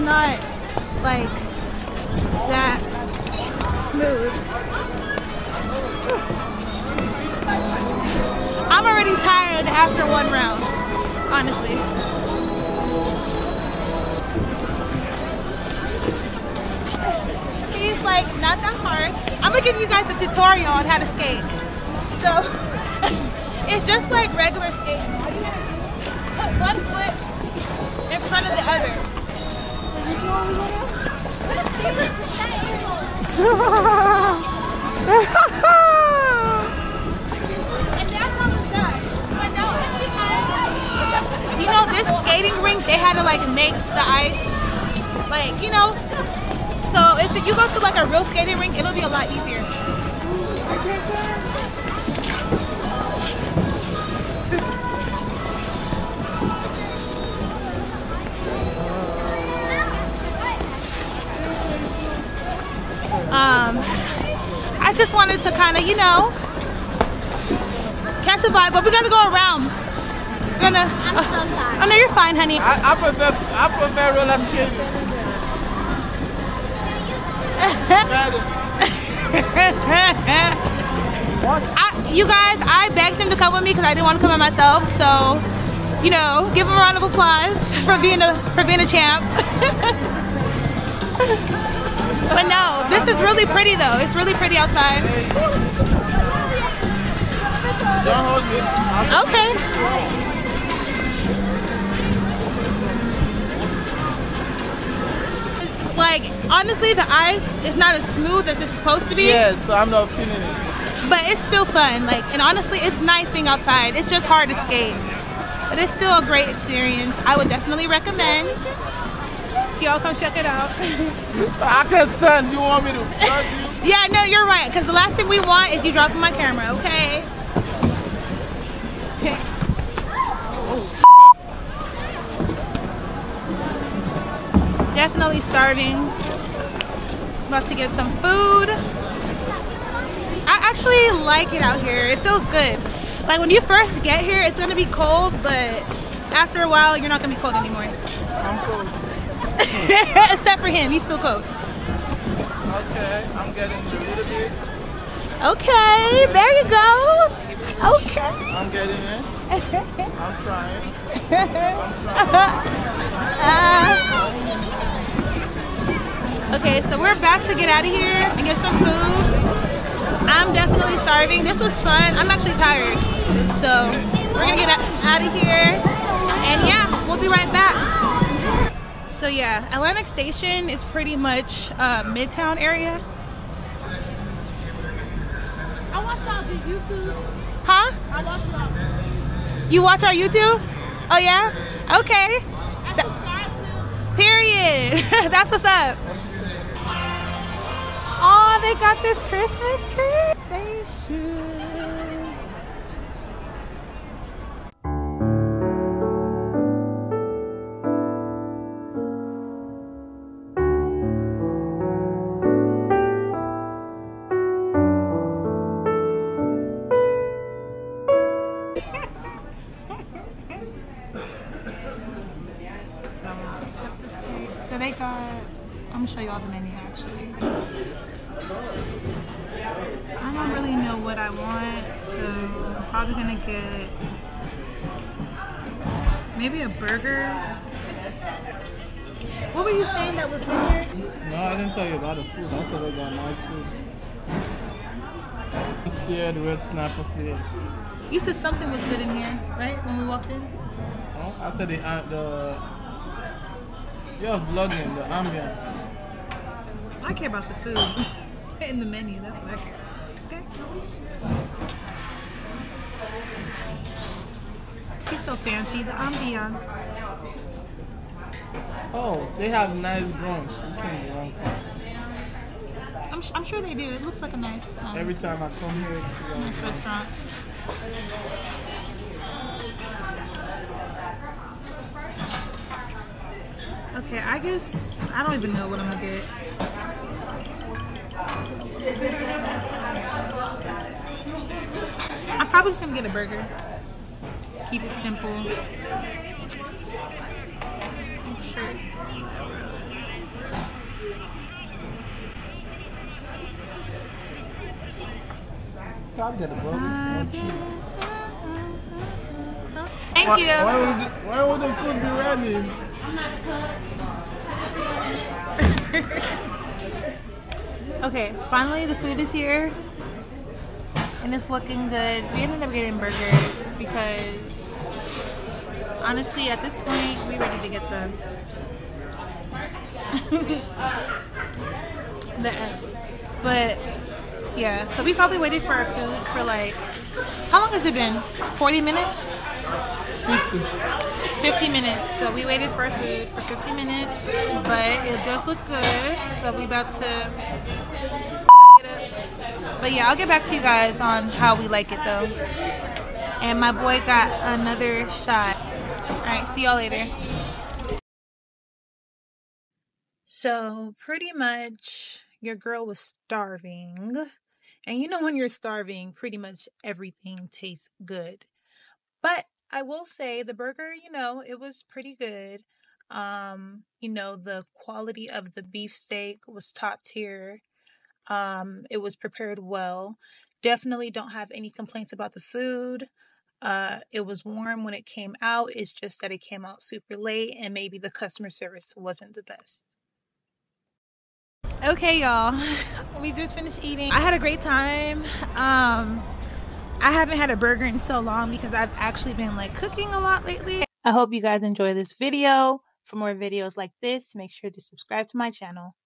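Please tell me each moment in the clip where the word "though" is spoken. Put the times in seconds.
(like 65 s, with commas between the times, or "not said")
93 s, 352 s.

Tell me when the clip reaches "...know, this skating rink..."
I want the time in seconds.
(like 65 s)
41 s.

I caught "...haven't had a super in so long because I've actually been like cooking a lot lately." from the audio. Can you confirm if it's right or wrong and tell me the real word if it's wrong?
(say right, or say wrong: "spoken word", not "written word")
wrong: "burger", not "super".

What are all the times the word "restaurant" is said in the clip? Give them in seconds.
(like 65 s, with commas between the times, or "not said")
276 s.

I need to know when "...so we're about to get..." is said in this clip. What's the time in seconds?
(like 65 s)
166 s.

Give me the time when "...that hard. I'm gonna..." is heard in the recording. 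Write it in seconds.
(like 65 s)
18 s.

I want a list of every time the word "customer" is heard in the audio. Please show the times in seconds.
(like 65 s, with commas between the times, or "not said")
388 s.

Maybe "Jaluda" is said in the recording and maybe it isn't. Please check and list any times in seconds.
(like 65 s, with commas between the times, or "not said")
153 s.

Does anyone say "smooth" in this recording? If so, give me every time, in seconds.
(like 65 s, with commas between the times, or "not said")
3 s, 108 s.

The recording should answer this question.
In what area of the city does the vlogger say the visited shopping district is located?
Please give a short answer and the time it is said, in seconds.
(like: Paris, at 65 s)
Midtown, at 182 s.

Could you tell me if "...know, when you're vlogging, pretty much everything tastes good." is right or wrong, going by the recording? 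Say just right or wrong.
wrong.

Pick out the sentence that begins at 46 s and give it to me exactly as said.
So if you go to like a real skating rink, it'll be a lot easier.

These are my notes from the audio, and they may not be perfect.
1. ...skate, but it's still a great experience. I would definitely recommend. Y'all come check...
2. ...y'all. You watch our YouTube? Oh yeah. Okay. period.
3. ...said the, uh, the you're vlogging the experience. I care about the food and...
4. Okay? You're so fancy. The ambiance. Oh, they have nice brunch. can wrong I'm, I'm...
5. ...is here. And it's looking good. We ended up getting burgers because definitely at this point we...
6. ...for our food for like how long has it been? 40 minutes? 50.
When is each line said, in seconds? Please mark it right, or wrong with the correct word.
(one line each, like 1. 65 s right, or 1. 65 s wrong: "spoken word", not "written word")
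1. 114 s right
2. 188 s right
3. 251 s wrong: "ambience", not "experience"
4. 264 s right
5. 319 s wrong: "honestly", not "definitely"
6. 335 s right.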